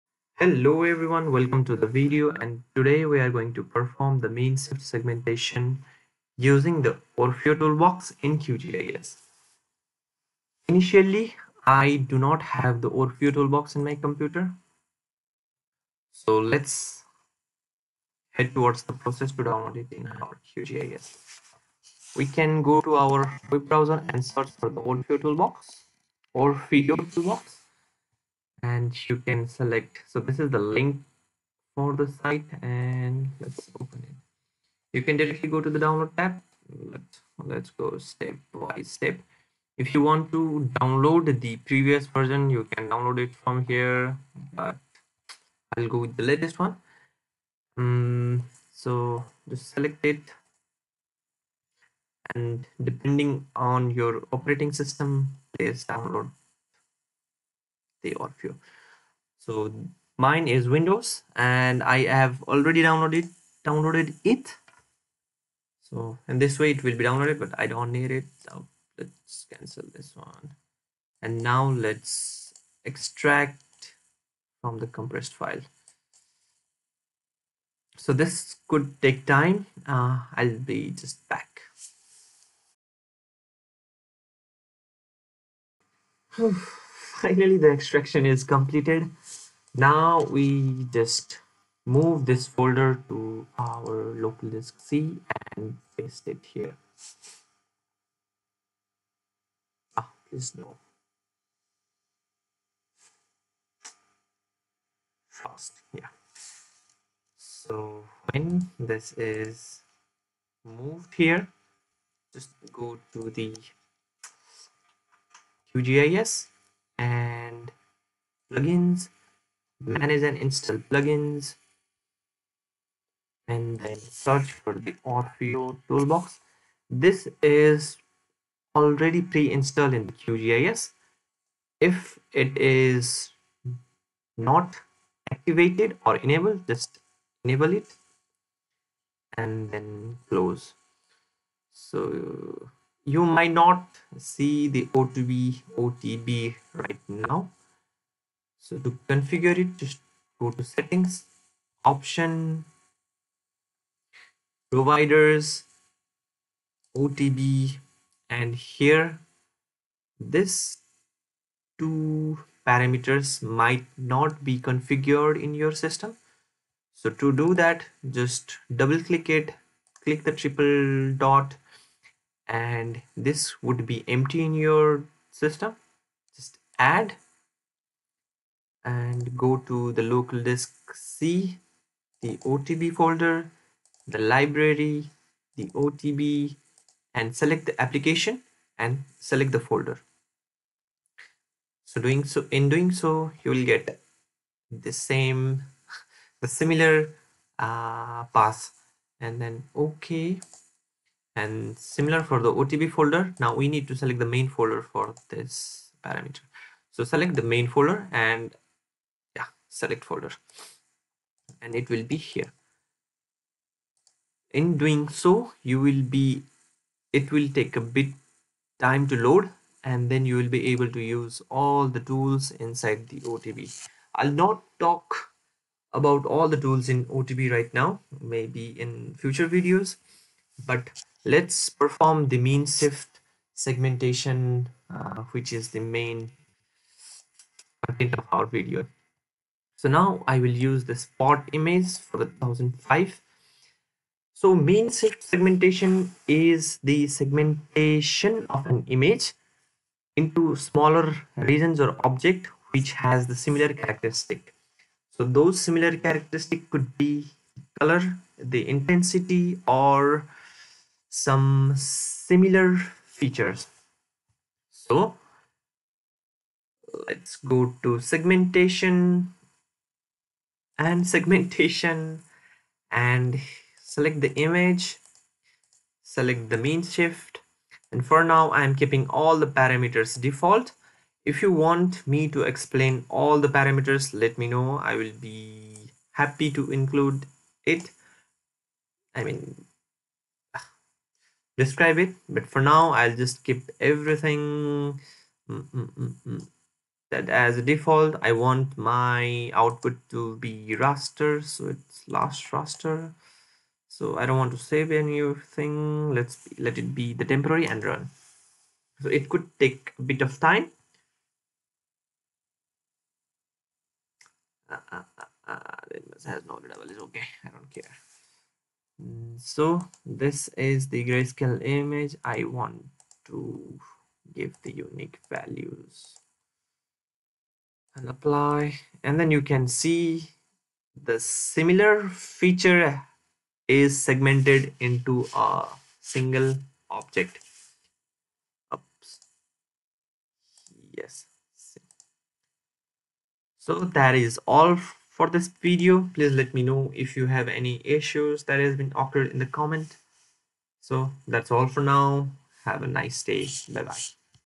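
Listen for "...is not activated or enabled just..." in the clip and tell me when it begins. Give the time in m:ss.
2:12.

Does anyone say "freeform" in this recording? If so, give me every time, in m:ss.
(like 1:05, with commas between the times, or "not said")
not said.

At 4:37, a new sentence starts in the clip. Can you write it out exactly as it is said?
And for now, I'm keeping all the parameters default.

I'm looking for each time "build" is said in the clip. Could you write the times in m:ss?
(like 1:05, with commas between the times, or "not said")
not said.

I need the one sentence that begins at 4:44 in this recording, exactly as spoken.
I will be happy to include it.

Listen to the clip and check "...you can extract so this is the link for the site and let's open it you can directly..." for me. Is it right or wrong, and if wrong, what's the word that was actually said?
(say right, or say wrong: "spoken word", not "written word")
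wrong: "select", not "extract".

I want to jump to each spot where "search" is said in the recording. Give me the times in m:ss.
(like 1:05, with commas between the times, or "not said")
0:24, 2:04.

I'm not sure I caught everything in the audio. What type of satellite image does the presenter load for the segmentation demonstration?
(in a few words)
SPOT image.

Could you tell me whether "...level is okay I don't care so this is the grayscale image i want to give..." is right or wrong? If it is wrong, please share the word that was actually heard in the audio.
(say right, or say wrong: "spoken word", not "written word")
right.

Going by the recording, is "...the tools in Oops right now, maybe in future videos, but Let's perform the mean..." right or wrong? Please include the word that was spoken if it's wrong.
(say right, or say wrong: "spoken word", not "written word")
wrong: "OTB", not "Oops".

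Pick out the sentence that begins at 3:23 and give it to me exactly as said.
Now we need to select the main folder for this parameter.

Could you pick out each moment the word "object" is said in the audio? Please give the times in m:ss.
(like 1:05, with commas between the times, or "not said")
4:12, 5:36.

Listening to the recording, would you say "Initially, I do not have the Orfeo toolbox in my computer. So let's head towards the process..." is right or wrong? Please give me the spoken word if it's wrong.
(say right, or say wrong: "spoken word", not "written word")
right.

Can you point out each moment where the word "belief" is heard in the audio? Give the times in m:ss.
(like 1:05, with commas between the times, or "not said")
not said.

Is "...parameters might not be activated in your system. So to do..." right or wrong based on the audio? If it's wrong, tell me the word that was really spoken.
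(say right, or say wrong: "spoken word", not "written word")
wrong: "configured", not "activated".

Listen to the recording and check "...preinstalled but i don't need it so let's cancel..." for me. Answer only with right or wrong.
wrong.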